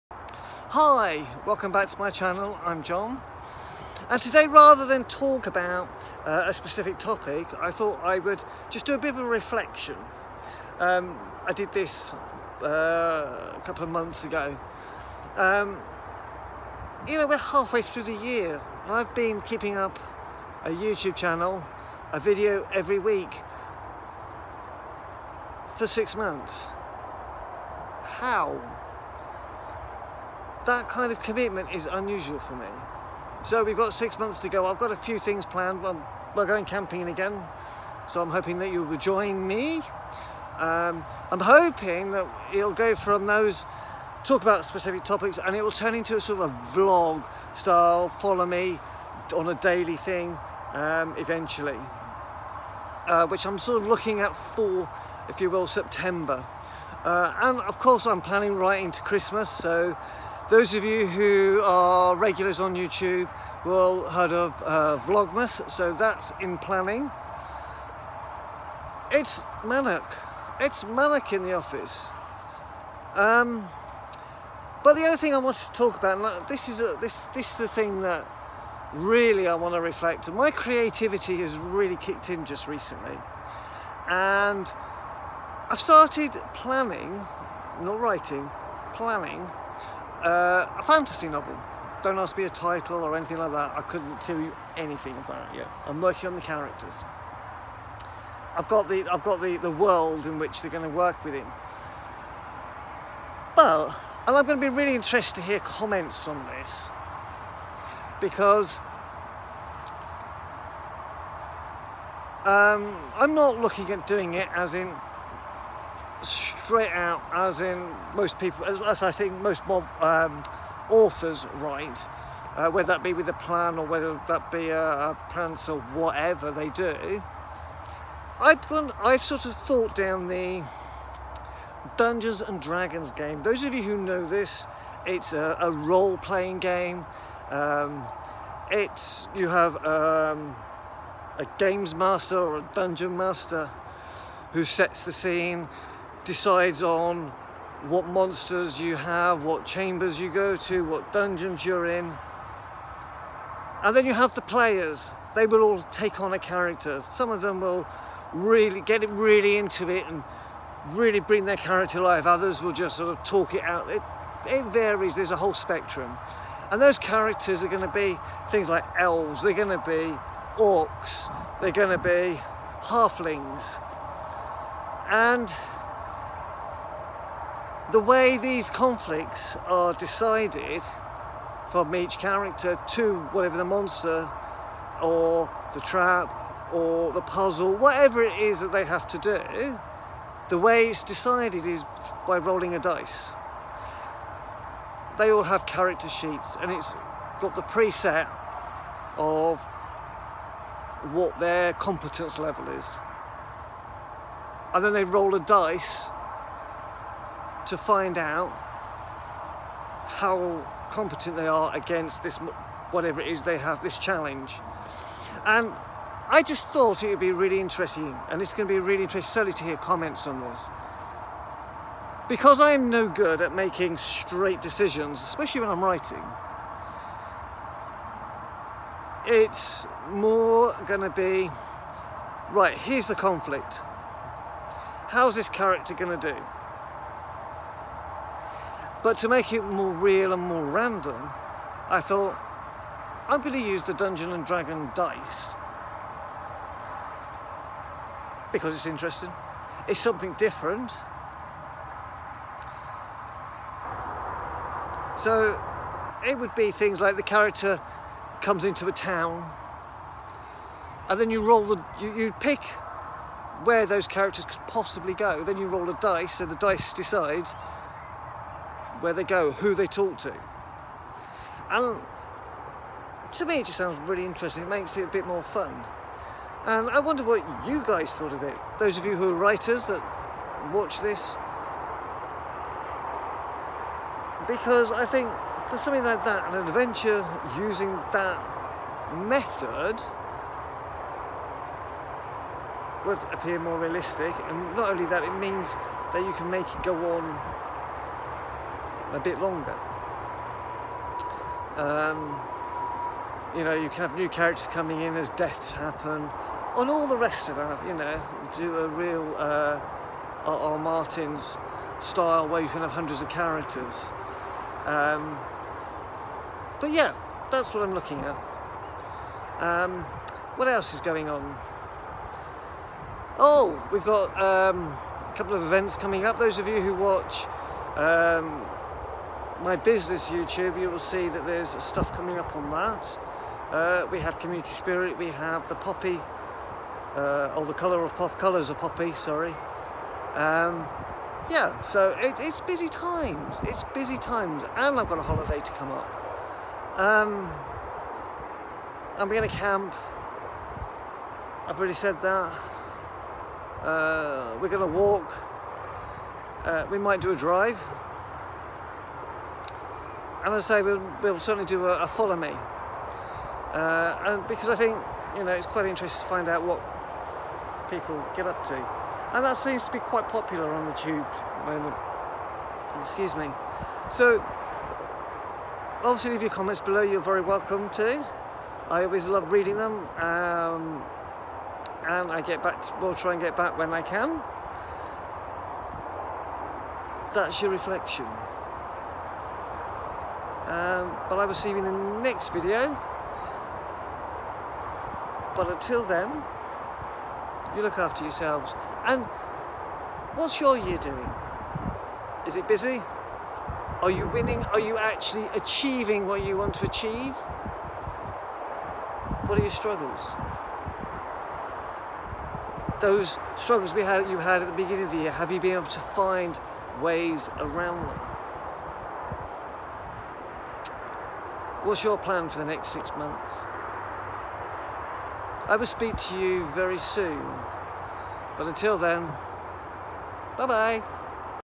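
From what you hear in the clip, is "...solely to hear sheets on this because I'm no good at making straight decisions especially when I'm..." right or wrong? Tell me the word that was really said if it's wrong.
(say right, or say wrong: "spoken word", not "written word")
wrong: "comments", not "sheets".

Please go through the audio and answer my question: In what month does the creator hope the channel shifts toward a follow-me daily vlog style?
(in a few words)
September.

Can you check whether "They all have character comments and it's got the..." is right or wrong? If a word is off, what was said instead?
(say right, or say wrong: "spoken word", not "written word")
wrong: "sheets", not "comments".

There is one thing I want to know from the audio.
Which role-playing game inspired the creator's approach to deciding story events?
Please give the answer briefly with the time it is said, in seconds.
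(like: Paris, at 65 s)
Dungeons and Dragons, at 131 s.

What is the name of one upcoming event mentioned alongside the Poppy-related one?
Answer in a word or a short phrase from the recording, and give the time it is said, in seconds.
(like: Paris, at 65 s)
Community Spirit, at 334 s.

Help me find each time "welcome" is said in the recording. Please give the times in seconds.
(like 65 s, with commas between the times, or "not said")
1 s, 377 s.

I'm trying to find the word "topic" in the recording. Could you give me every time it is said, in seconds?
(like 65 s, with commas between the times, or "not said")
6 s, 45 s.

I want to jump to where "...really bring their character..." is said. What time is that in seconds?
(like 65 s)
160 s.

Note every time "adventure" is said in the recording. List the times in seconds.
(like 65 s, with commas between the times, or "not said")
286 s.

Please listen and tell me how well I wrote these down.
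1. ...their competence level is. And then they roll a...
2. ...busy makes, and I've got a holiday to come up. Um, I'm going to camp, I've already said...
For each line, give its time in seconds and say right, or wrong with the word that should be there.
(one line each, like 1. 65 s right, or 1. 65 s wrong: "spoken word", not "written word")
1. 201 s right
2. 343 s wrong: "times", not "makes".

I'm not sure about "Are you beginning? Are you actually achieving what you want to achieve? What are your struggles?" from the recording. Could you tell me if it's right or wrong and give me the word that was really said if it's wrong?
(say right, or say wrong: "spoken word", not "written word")
wrong: "winning", not "beginning".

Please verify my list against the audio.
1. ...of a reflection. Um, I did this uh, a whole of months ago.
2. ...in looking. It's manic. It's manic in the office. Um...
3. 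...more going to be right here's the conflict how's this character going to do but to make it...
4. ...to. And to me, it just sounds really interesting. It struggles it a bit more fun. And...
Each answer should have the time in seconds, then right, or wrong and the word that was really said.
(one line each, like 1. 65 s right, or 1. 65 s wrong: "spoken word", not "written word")
1. 9 s wrong: "couple", not "whole"
2. 66 s wrong: "planning", not "looking"
3. 230 s right
4. 270 s wrong: "makes", not "struggles".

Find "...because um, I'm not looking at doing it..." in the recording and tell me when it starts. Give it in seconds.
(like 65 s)
108 s.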